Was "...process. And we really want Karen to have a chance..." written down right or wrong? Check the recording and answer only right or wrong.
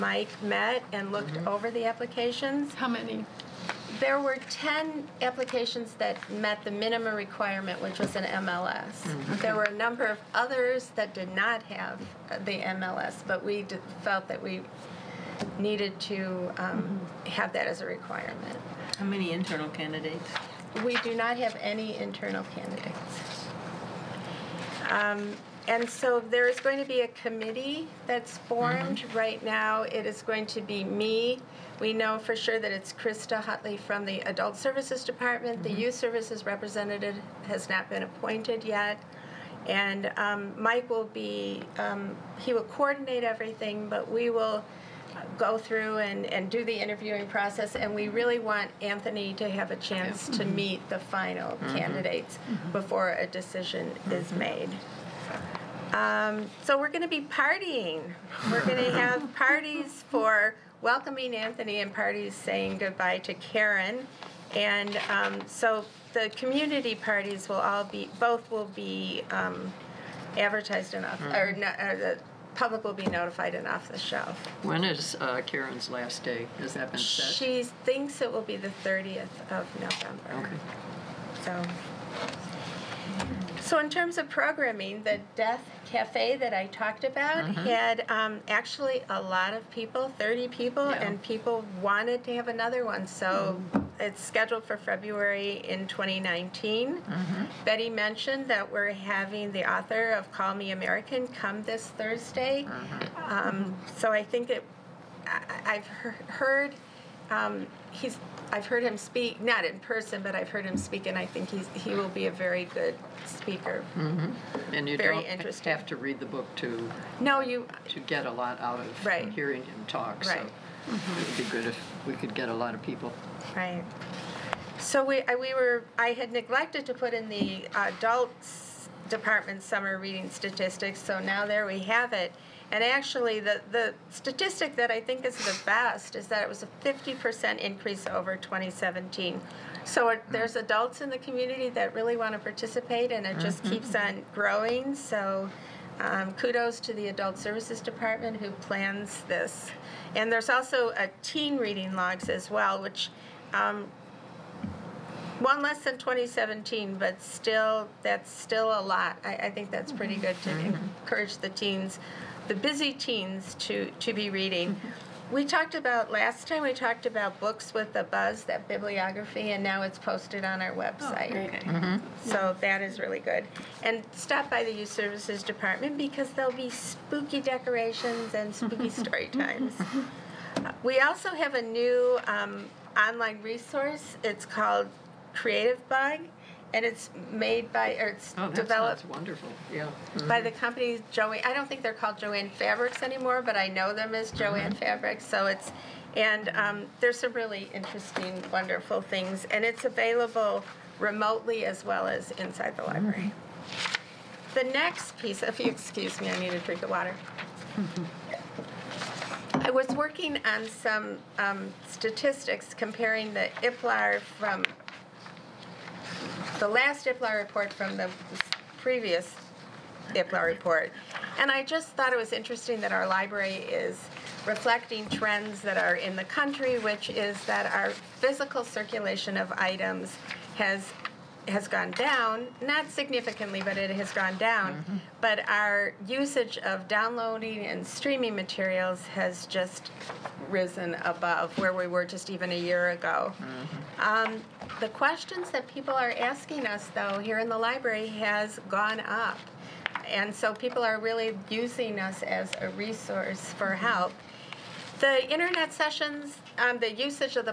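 wrong.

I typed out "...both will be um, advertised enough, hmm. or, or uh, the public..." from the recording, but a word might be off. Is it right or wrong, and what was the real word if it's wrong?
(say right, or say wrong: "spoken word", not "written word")
right.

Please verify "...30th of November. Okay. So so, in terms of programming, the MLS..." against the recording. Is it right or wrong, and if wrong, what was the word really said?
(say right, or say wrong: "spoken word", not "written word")
wrong: "Death", not "MLS".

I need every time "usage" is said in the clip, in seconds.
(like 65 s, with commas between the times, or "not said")
236 s, 256 s.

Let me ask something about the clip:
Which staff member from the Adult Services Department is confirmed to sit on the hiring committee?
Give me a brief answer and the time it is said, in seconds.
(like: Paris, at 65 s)
Krista Hutley, at 32 s.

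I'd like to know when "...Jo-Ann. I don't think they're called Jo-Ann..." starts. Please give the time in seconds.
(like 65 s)
191 s.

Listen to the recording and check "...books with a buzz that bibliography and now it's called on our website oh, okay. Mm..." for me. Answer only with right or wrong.
wrong.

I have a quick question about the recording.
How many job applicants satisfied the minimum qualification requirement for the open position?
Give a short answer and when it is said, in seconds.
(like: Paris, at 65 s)
10, at 4 s.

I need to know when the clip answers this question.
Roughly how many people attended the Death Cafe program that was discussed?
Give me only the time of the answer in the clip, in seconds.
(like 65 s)
90 s.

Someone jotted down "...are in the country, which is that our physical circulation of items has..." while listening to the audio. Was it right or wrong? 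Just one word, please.
right.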